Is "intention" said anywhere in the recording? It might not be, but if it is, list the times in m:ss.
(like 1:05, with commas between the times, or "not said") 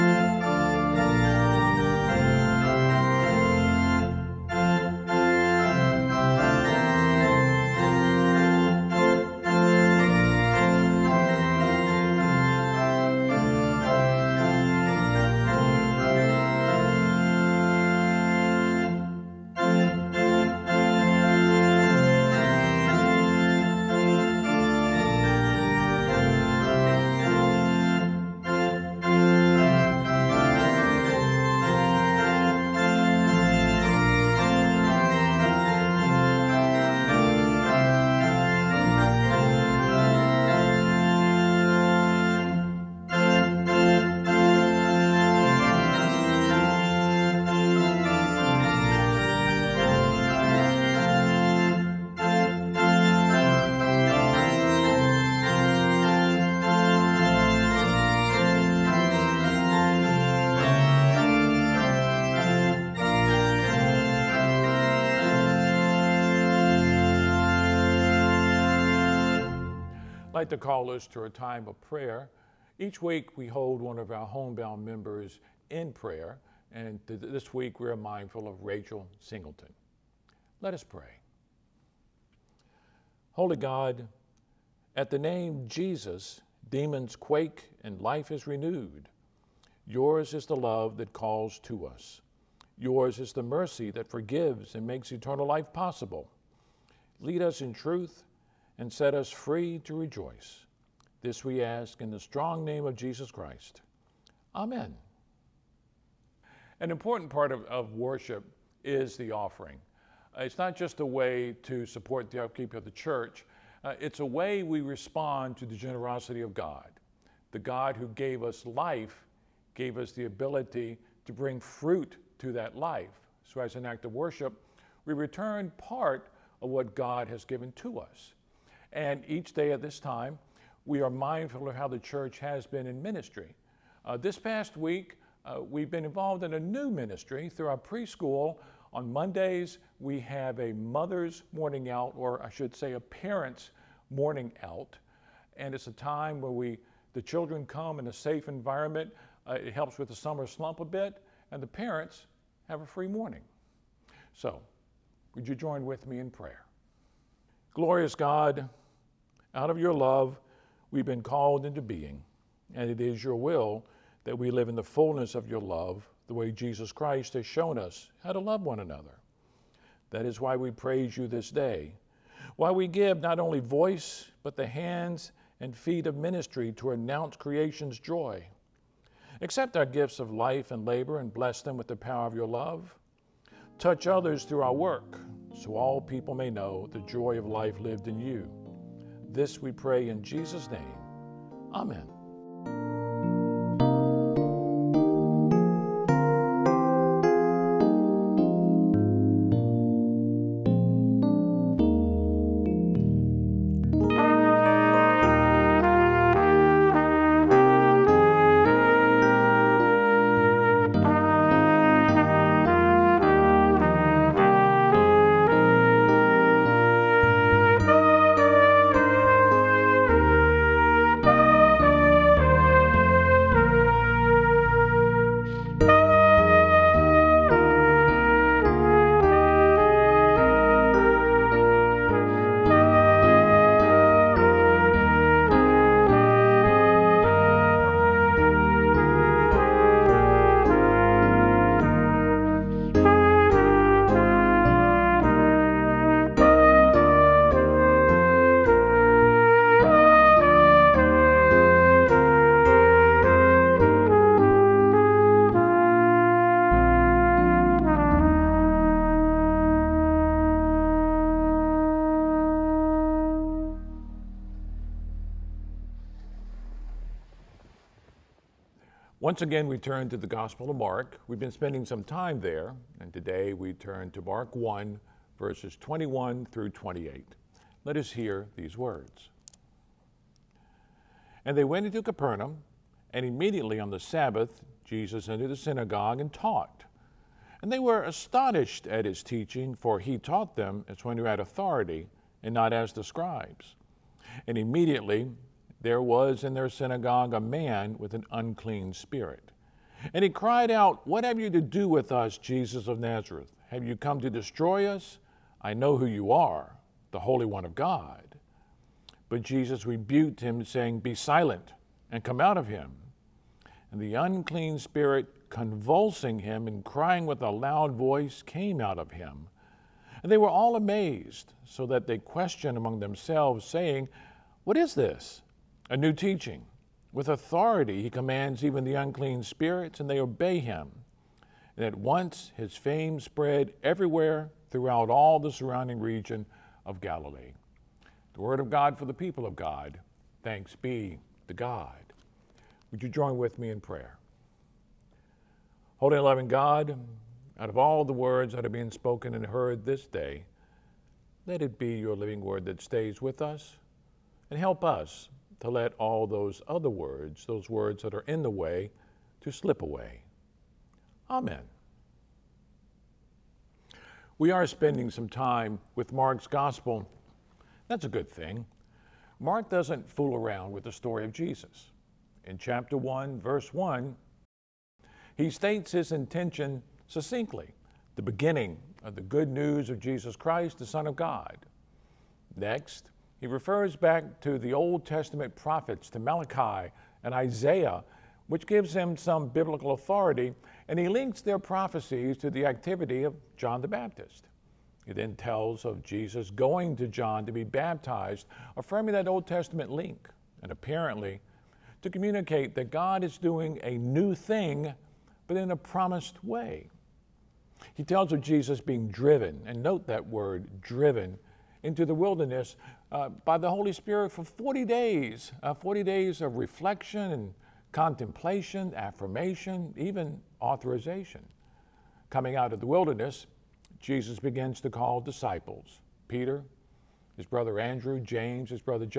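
6:16.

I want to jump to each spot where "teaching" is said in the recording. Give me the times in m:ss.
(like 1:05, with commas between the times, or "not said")
4:49, 5:26.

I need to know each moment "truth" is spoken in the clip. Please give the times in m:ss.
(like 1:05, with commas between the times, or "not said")
1:37.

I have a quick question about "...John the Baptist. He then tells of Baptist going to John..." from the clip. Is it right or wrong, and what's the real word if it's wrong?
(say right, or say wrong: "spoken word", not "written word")
wrong: "Jesus", not "Baptist".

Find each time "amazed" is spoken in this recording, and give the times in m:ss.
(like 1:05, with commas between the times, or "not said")
5:20.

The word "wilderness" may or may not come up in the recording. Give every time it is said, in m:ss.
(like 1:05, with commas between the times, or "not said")
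6:52, 7:02.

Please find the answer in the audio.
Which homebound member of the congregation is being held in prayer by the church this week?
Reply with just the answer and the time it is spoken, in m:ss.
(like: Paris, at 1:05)
Rachel Singleton, at 1:18.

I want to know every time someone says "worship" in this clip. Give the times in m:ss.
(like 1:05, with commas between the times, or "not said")
1:47, 2:04.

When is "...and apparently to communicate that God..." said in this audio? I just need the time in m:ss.
6:40.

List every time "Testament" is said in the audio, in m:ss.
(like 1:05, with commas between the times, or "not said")
6:25, 6:39.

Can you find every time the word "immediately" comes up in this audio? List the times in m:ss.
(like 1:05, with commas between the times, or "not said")
4:43, 4:54.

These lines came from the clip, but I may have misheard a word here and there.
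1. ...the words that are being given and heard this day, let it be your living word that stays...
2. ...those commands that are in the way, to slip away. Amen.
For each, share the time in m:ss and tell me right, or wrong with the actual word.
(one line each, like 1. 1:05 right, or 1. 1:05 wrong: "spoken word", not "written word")
1. 5:48 wrong: "spoken", not "given"
2. 5:57 wrong: "words", not "commands".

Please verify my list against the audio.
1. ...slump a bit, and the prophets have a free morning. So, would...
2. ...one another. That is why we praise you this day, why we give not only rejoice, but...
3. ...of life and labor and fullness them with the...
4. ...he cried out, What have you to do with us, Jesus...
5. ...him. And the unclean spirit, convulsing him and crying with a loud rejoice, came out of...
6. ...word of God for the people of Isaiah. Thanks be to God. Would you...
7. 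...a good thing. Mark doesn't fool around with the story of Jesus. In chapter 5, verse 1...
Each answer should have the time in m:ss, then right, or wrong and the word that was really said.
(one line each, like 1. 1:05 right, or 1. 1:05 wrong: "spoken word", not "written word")
1. 2:30 wrong: "parents", not "prophets"
2. 2:48 wrong: "voice", not "rejoice"
3. 3:00 wrong: "bless", not "fullness"
4. 5:00 right
5. 5:12 wrong: "voice", not "rejoice"
6. 5:38 wrong: "God", not "Isaiah"
7. 6:08 wrong: "1", not "5".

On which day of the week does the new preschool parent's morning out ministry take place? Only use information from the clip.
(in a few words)
Mondays.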